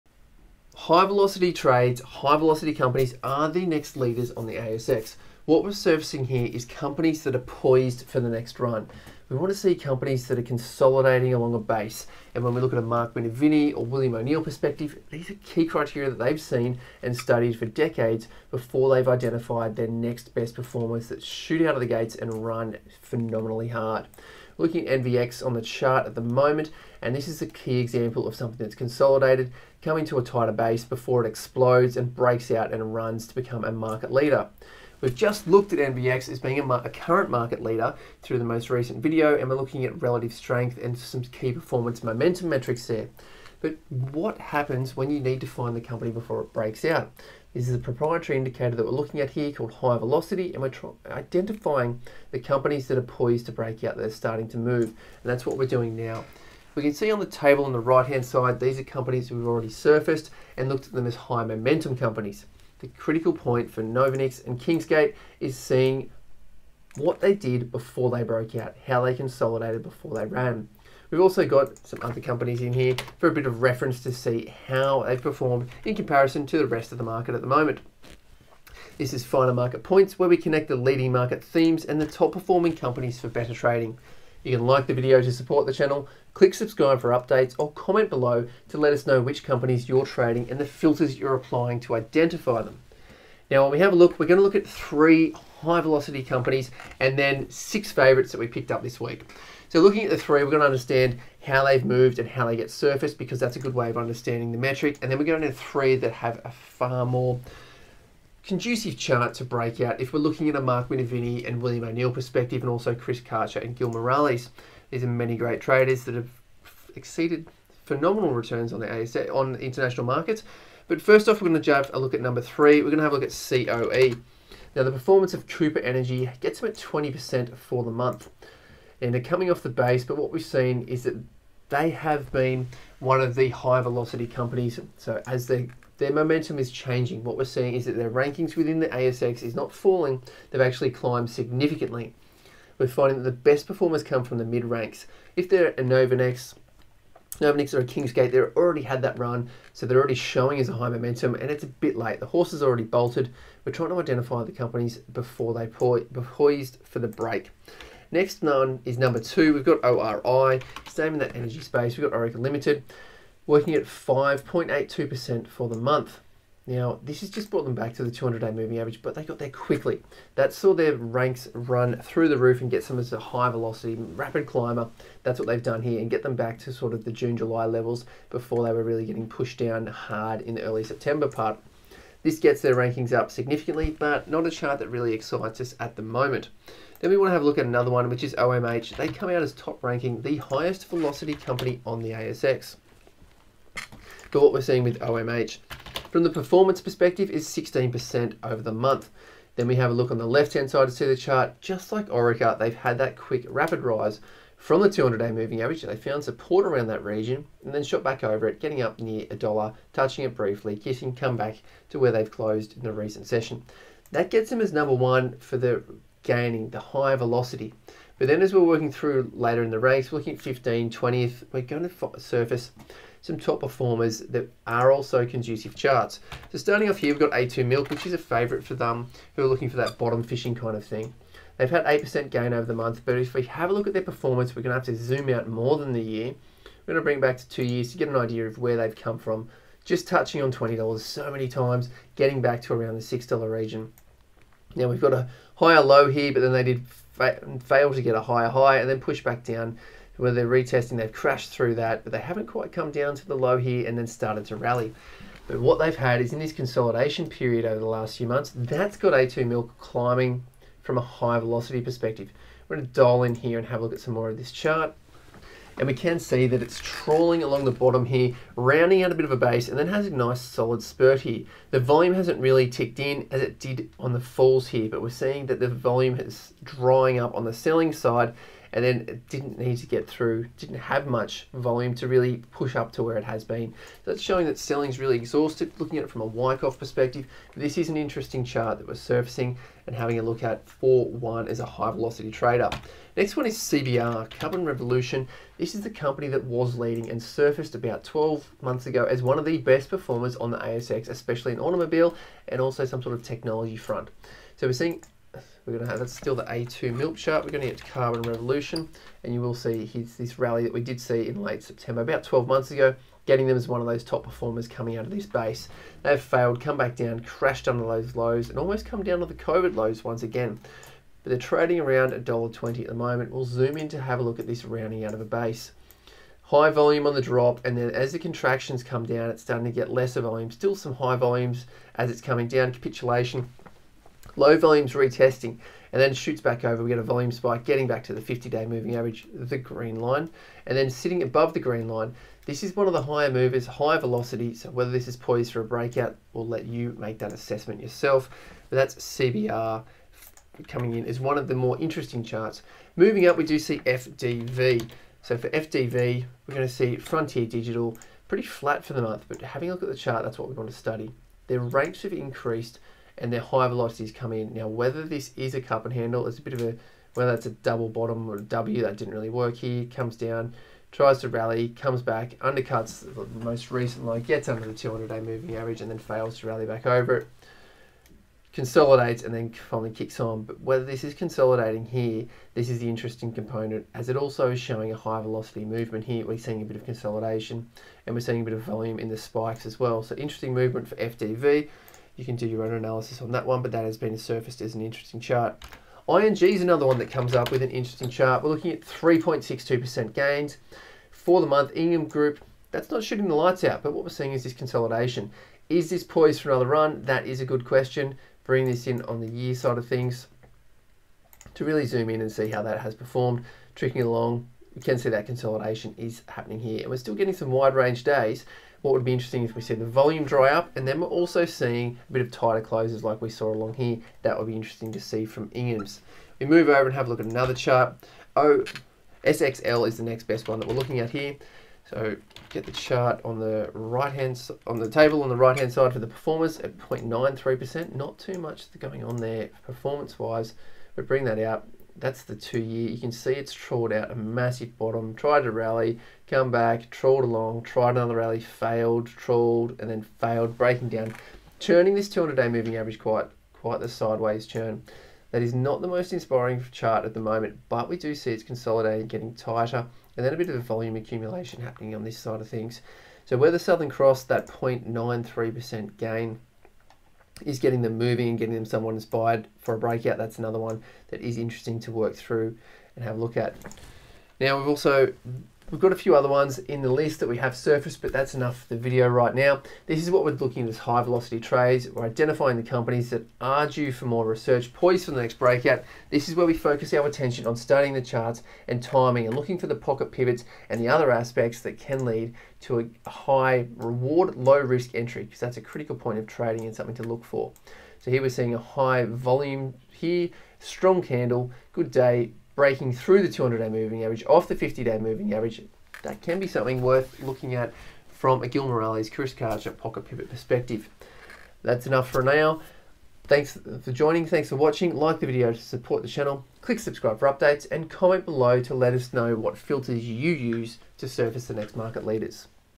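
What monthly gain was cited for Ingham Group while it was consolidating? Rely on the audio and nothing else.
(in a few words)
3.62%.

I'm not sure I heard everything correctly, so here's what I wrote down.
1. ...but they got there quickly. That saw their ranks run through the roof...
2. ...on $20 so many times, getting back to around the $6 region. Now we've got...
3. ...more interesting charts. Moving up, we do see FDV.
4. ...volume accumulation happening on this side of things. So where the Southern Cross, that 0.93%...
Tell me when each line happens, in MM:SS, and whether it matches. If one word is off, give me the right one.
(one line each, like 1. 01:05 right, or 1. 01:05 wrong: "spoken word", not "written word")
1. 02:49 right
2. 04:00 right
3. 05:51 right
4. 07:40 right.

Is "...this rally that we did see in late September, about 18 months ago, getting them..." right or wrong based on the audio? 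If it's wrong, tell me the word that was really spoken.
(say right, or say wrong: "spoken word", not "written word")
wrong: "12", not "18".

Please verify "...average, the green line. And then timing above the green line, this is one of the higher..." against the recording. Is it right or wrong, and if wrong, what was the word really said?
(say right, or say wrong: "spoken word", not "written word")
wrong: "sitting", not "timing".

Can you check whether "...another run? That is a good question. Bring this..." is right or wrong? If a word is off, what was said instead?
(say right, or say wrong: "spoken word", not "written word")
right.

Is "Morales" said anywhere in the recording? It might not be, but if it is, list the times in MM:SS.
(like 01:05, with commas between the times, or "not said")
01:53, 08:28.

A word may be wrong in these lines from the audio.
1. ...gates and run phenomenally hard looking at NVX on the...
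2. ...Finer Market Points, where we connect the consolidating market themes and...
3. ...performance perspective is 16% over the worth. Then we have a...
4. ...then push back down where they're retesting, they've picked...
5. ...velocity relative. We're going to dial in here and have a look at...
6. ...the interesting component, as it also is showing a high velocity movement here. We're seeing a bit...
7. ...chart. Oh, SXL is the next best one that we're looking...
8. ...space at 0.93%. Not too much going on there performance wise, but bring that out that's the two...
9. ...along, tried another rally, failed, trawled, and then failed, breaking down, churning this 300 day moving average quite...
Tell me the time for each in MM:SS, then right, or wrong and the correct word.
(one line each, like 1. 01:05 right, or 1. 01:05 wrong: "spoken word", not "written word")
1. 00:21 right
2. 01:19 wrong: "leading", not "consolidating"
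3. 03:16 wrong: "month", not "worth"
4. 04:08 wrong: "crashed", not "picked"
5. 04:21 wrong: "perspective", not "relative"
6. 06:22 right
7. 07:07 right
8. 07:16 wrong: "performance", not "space"
9. 07:27 wrong: "200", not "300".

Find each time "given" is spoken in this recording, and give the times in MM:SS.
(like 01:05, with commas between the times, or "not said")
not said.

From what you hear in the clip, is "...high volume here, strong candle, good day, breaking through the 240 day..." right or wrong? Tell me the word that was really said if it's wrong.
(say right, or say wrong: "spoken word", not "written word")
wrong: "200", not "240".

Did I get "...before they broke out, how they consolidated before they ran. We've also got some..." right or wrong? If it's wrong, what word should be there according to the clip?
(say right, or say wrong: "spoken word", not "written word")
right.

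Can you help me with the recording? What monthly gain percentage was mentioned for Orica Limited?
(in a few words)
5.82%.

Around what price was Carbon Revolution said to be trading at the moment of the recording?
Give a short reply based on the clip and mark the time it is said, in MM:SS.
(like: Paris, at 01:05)
$1.20, at 05:22.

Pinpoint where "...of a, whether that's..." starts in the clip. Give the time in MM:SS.
06:06.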